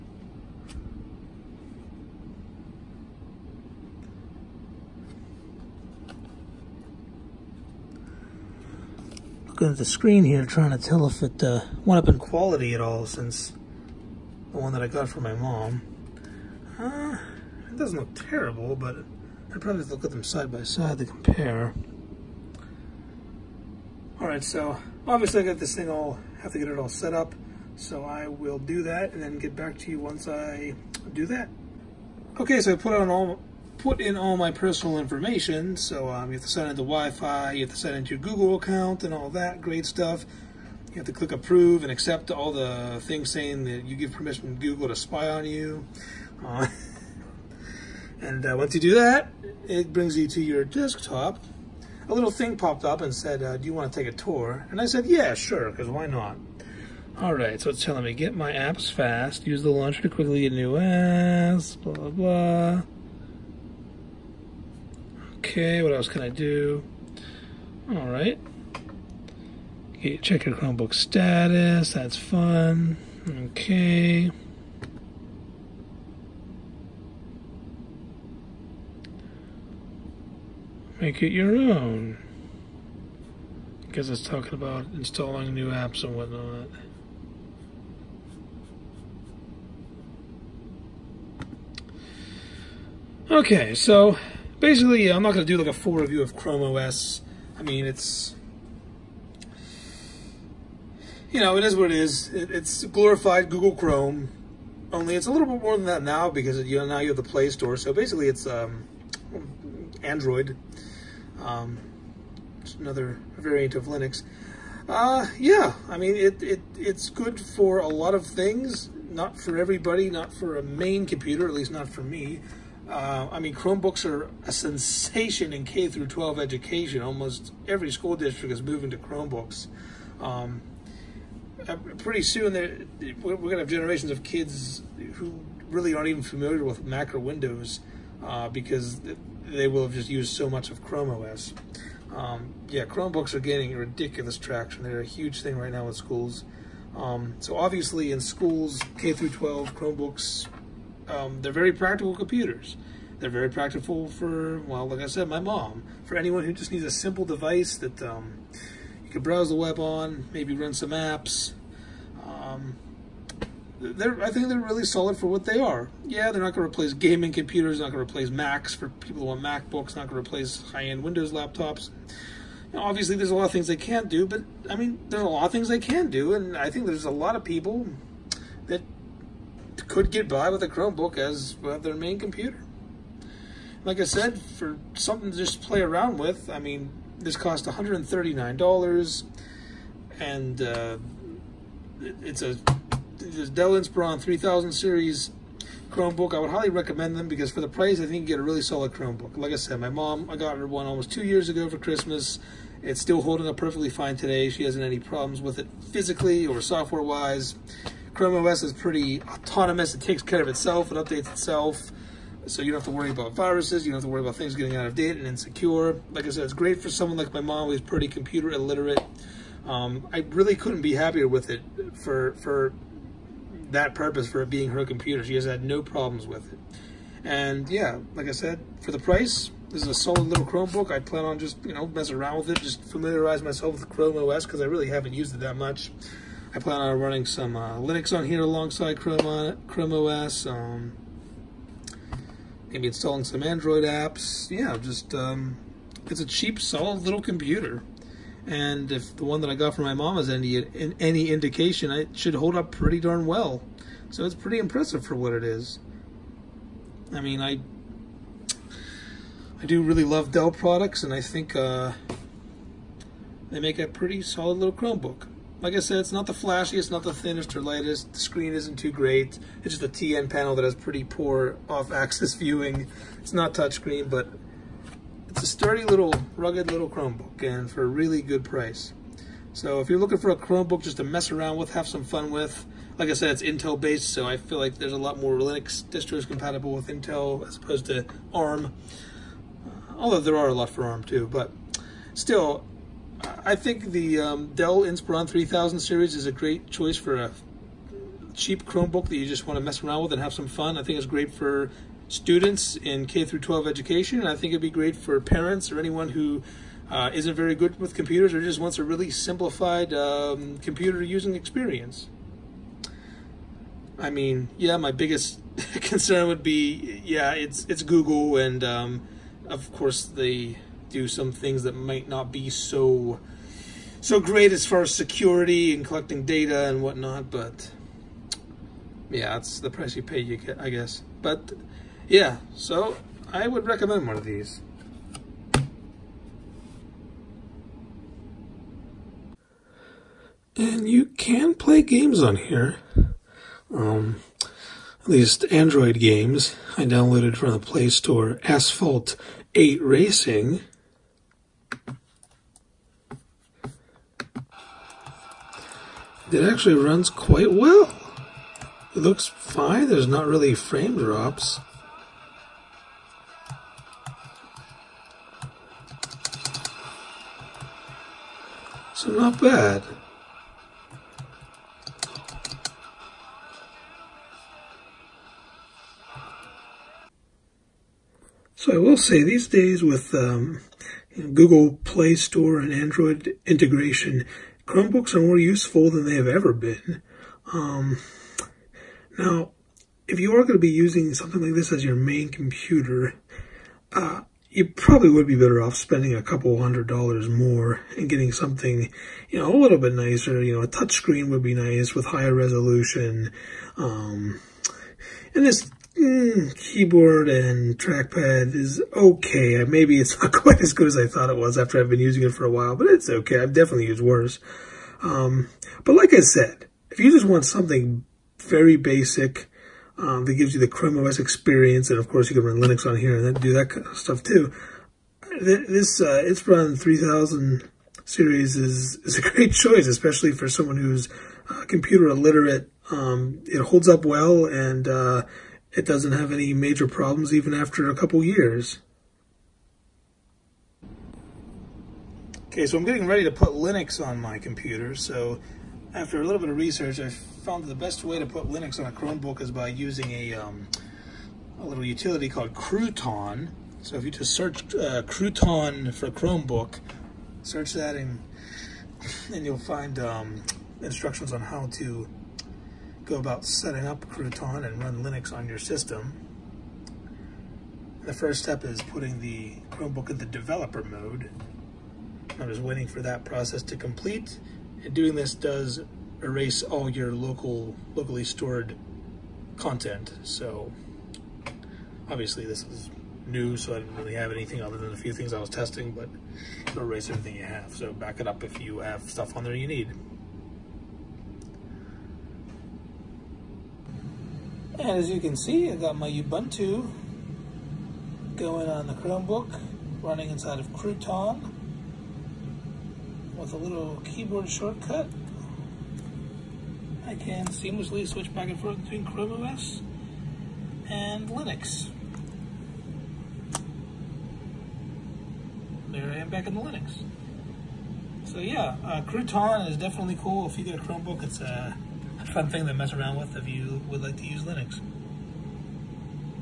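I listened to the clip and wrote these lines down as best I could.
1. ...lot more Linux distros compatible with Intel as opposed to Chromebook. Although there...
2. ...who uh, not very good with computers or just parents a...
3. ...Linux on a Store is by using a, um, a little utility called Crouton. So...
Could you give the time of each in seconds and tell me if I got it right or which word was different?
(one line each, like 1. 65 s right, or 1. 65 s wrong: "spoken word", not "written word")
1. 284 s wrong: "ARM", not "Chromebook"
2. 306 s wrong: "wants", not "parents"
3. 448 s wrong: "Chromebook", not "Store".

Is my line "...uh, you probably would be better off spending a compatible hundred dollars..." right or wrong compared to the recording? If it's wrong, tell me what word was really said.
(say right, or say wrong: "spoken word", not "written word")
wrong: "couple", not "compatible".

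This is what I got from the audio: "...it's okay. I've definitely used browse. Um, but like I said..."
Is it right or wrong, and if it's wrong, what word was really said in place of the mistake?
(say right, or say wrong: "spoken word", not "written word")
wrong: "worse", not "browse".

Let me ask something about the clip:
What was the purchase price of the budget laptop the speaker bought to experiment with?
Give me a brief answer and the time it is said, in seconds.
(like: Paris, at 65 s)
$139, at 187 s.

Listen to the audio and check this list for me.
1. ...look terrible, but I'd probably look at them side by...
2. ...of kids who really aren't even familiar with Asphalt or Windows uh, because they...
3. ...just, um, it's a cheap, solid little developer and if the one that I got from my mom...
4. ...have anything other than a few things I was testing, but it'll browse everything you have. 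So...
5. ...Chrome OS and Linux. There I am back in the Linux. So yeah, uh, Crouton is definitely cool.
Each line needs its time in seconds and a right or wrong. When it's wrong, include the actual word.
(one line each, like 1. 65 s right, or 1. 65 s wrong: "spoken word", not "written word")
1. 17 s right
2. 134 s wrong: "Mac", not "Asphalt"
3. 244 s wrong: "computer", not "developer"
4. 484 s wrong: "erase", not "browse"
5. 509 s right.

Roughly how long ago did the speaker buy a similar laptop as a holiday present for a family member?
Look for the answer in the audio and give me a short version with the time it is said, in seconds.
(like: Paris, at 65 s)
almost two years, at 200 s.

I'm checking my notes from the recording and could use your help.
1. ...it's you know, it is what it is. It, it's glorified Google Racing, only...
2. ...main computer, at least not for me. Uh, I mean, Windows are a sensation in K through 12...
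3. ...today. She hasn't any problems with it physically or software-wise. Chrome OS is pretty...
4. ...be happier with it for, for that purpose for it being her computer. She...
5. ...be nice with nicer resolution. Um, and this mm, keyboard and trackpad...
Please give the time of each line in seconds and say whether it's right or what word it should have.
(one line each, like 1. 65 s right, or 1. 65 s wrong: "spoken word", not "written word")
1. 97 s wrong: "Chrome", not "Racing"
2. 120 s wrong: "Chromebooks", not "Windows"
3. 204 s right
4. 220 s right
5. 401 s wrong: "higher", not "nicer".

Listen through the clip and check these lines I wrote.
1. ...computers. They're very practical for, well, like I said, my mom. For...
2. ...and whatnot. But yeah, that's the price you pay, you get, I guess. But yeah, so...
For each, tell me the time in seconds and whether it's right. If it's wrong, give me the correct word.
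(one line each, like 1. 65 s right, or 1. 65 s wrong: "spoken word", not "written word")
1. 152 s right
2. 326 s right.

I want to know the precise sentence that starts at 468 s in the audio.
The first step is putting the Chromebook in the developer mode.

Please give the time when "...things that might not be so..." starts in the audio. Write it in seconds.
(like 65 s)
321 s.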